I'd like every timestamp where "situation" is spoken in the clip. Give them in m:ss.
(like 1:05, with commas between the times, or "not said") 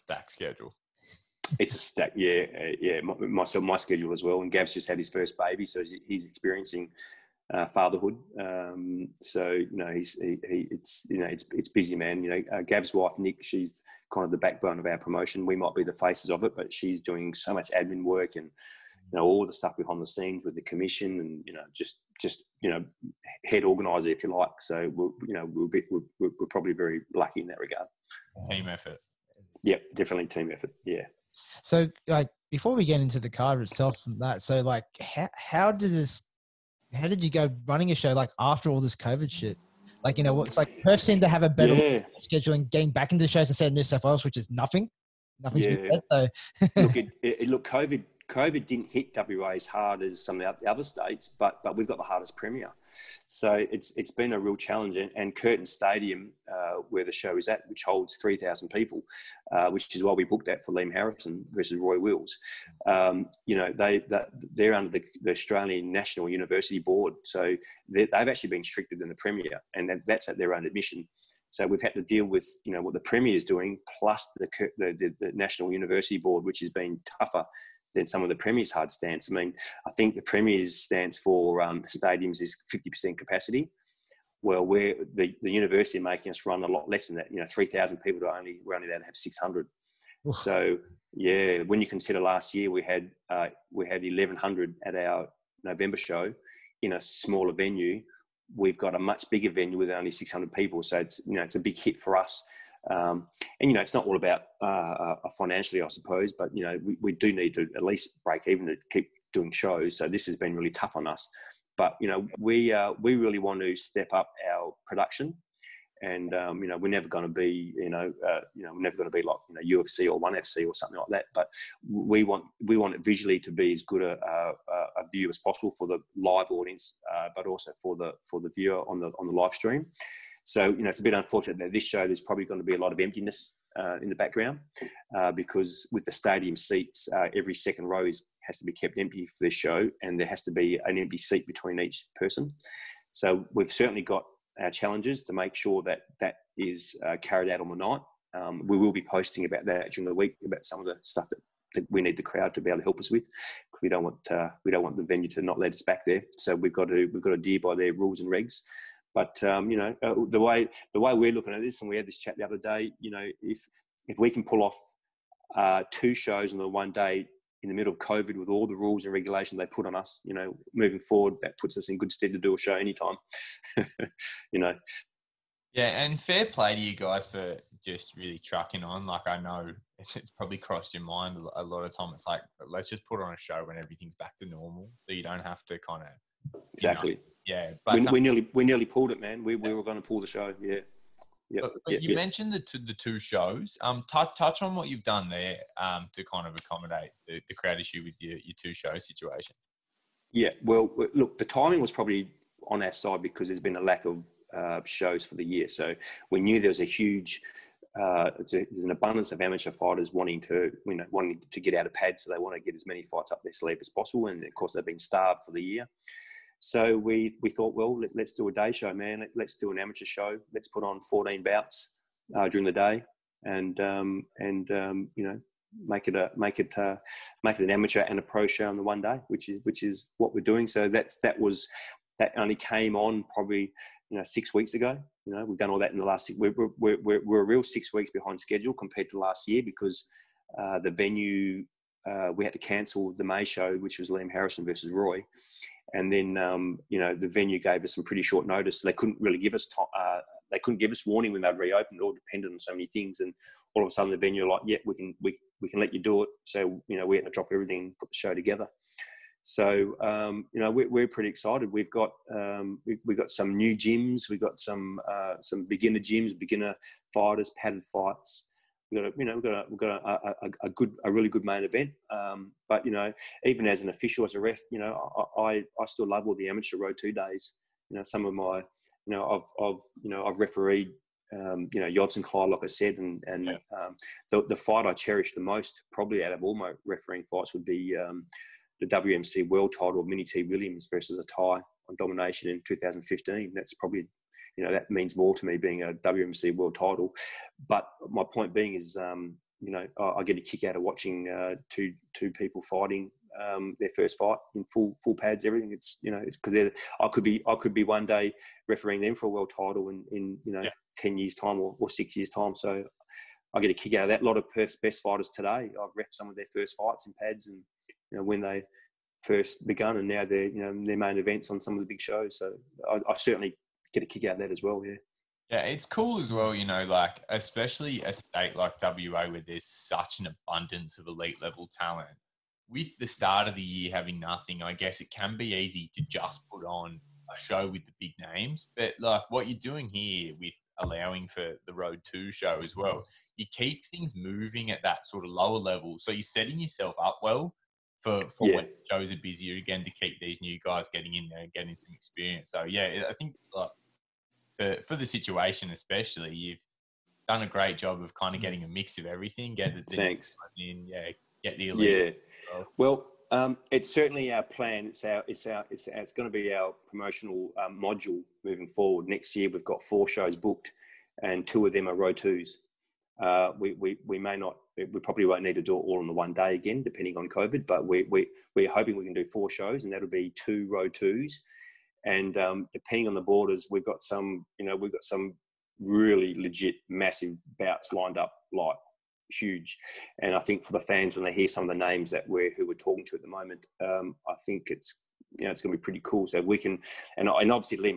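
3:18, 5:55.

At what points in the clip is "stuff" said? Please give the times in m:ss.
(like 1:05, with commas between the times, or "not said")
0:19, 2:31.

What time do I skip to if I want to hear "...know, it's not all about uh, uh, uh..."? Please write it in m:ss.
1:43.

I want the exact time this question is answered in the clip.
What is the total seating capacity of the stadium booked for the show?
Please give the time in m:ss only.
0:58.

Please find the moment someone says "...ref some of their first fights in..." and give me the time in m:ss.
5:15.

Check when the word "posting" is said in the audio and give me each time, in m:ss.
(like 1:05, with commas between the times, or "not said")
2:29.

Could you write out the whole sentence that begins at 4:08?
So they couldn't really give us to, uh, they couldn't give us warning when they'd reopen.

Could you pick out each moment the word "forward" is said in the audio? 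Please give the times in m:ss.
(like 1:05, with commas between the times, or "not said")
2:50, 6:08.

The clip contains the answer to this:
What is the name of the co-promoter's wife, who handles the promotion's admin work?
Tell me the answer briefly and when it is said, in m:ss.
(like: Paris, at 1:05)
Nick, at 0:13.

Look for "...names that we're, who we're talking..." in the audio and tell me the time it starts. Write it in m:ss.
6:31.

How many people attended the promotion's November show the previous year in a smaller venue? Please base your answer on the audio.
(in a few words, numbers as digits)
1,100.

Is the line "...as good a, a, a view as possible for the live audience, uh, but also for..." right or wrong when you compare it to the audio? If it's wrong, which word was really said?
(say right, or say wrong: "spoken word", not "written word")
right.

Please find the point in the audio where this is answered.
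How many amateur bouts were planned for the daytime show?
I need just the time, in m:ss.
3:41.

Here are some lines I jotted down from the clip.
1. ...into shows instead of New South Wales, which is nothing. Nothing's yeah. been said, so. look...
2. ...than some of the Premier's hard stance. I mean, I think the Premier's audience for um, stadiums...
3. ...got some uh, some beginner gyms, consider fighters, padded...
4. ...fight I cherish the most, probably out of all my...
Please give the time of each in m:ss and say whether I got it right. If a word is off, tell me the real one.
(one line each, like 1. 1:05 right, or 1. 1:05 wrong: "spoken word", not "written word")
1. 0:43 right
2. 1:17 wrong: "stance", not "audience"
3. 4:24 wrong: "beginner", not "consider"
4. 4:44 right.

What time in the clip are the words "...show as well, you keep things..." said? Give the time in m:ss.
5:42.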